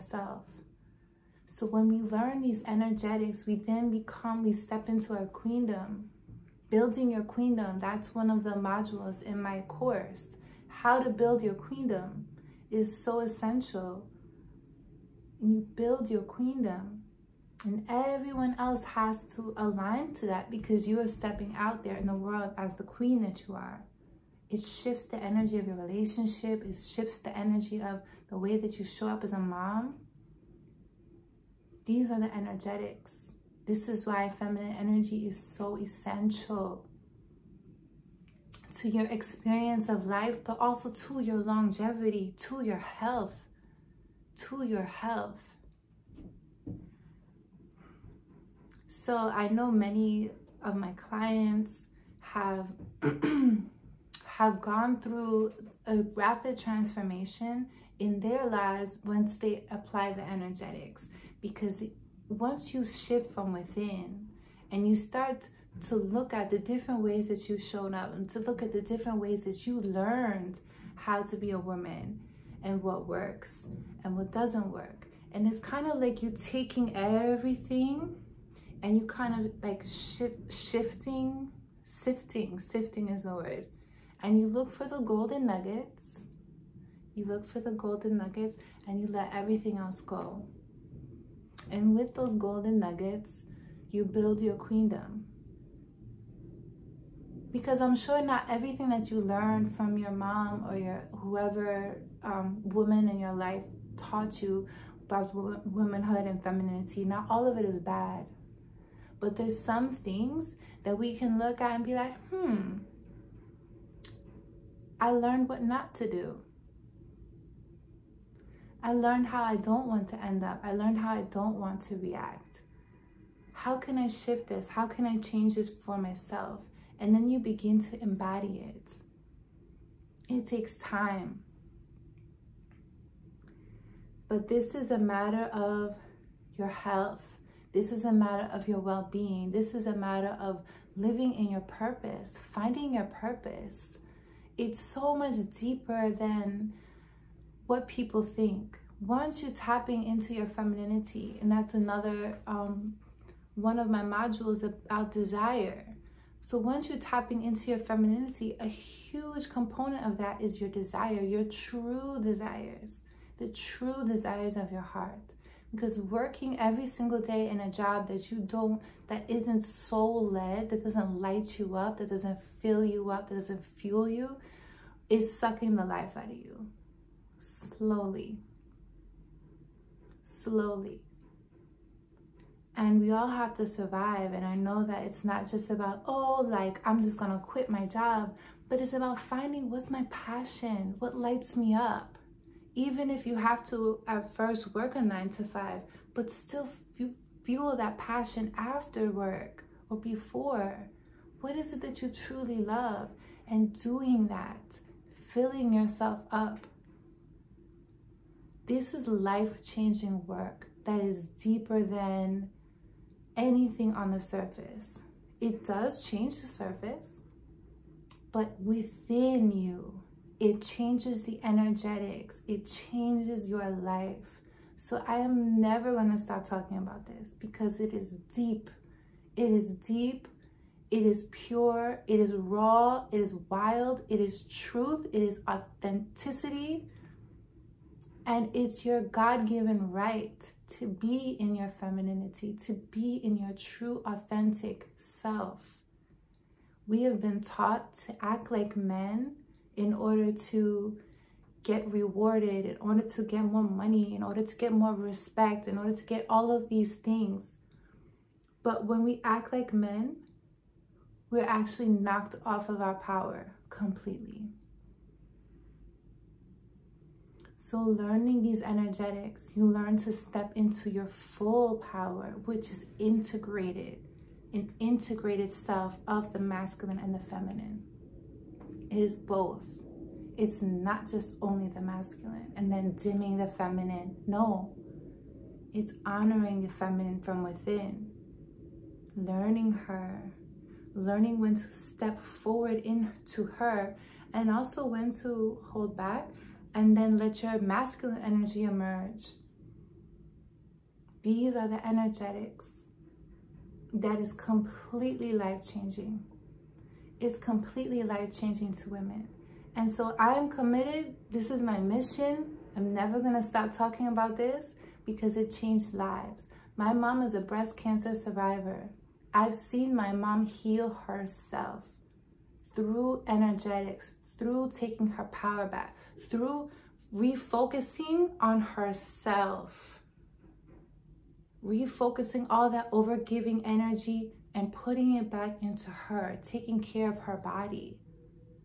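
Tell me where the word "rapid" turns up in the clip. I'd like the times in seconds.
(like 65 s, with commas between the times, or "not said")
56 s.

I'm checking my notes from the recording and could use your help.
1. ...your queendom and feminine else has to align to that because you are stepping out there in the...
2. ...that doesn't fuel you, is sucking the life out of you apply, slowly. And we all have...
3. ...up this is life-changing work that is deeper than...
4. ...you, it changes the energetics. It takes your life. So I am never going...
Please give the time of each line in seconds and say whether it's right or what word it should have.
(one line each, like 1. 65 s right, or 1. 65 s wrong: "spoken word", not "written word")
1. 16 s wrong: "everyone", not "feminine"
2. 173 s wrong: "slowly", not "apply"
3. 206 s right
4. 219 s wrong: "changes", not "takes".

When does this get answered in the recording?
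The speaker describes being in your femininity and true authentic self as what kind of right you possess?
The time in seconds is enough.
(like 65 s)
239 s.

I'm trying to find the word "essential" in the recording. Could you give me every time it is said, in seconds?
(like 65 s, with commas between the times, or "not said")
13 s, 35 s.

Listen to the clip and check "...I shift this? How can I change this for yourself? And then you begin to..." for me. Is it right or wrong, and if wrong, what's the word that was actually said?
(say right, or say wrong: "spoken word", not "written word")
wrong: "myself", not "yourself".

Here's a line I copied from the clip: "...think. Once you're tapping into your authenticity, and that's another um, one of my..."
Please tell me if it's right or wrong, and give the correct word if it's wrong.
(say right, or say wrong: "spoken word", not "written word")
wrong: "femininity", not "authenticity".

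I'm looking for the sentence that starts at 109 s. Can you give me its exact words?
But there's some things that we can look at and be like, hmm, I learned what not to do.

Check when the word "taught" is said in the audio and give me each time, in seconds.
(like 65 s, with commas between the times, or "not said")
103 s, 247 s.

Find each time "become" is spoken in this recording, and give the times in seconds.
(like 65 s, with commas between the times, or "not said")
3 s.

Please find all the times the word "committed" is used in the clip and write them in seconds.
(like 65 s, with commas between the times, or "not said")
310 s.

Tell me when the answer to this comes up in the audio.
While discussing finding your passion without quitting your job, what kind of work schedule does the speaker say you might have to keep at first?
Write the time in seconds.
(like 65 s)
195 s.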